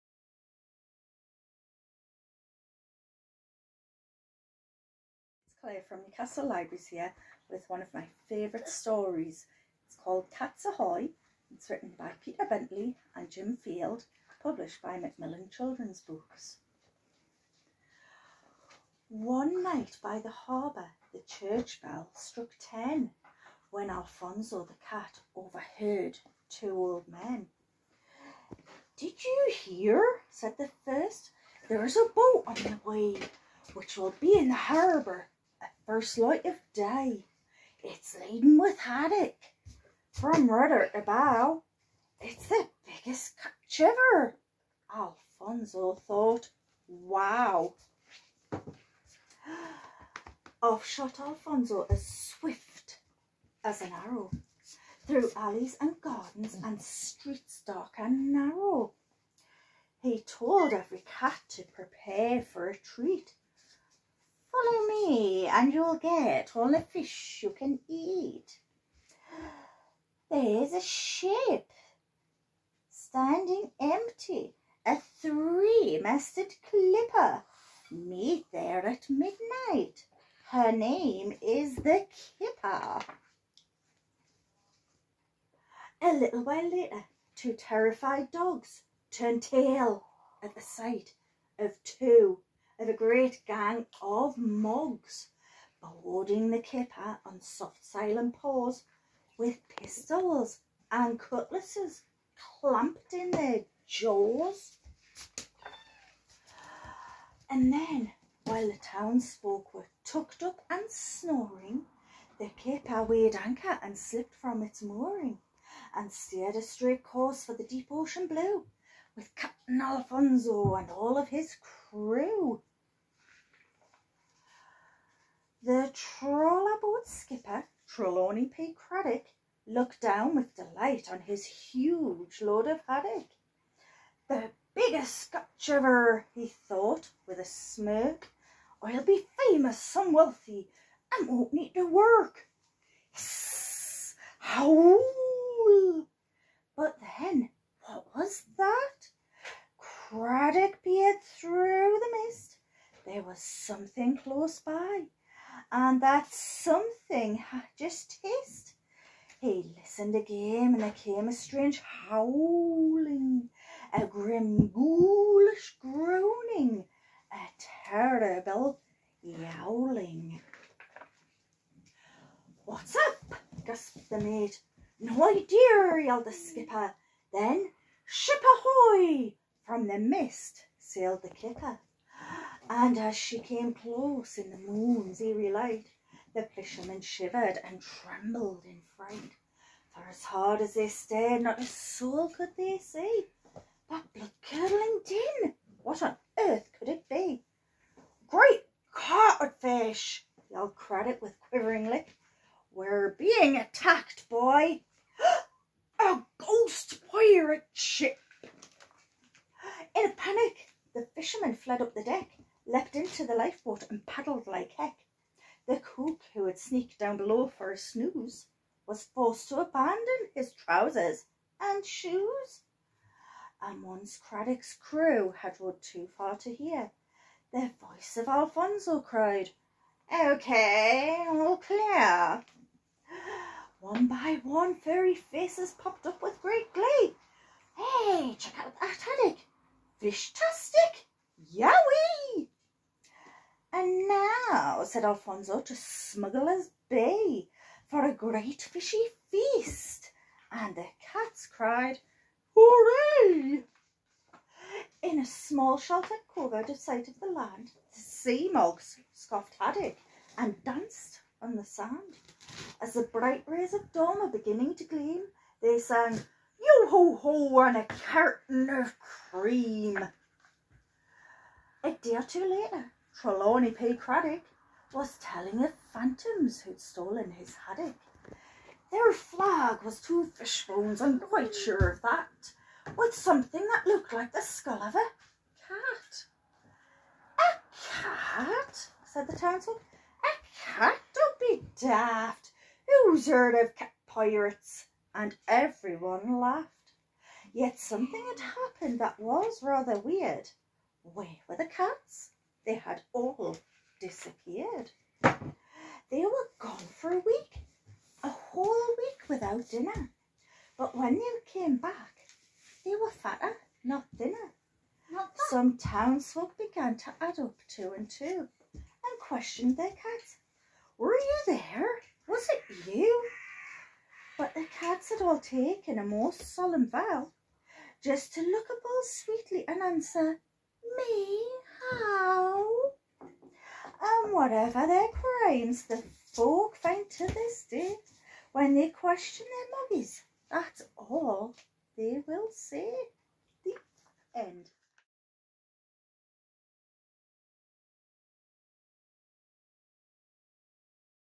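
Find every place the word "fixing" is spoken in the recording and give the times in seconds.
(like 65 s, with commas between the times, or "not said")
not said.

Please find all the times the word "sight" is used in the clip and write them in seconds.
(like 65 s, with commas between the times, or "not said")
90 s, 256 s.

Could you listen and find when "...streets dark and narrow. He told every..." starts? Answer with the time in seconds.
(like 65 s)
56 s.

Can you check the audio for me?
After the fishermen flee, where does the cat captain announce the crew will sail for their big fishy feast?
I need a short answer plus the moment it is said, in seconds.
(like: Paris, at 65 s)
Smuggler's Bay, at 245 s.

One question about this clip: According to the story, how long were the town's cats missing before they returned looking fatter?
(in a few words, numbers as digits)
A week.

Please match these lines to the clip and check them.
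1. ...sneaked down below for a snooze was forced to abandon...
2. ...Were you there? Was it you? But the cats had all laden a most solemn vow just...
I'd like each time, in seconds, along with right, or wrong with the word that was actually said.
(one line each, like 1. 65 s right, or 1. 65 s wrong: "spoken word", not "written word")
1. 216 s right
2. 320 s wrong: "taken", not "laden".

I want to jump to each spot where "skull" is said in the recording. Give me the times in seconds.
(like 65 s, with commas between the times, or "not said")
284 s.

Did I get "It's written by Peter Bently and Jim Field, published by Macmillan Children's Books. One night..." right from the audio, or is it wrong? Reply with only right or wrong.
right.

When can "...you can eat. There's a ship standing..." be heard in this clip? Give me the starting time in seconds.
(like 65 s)
67 s.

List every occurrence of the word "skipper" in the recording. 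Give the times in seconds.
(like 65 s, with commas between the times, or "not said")
127 s, 176 s.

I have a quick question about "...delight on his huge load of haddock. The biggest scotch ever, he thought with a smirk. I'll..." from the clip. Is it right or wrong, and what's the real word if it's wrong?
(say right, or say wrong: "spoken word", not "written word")
right.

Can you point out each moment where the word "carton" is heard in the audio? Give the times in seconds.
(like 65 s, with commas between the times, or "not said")
267 s.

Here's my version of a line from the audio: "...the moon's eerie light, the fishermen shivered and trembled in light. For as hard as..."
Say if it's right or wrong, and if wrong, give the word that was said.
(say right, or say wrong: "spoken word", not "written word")
wrong: "fright", not "light".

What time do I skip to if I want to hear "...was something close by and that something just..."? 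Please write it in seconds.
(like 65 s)
153 s.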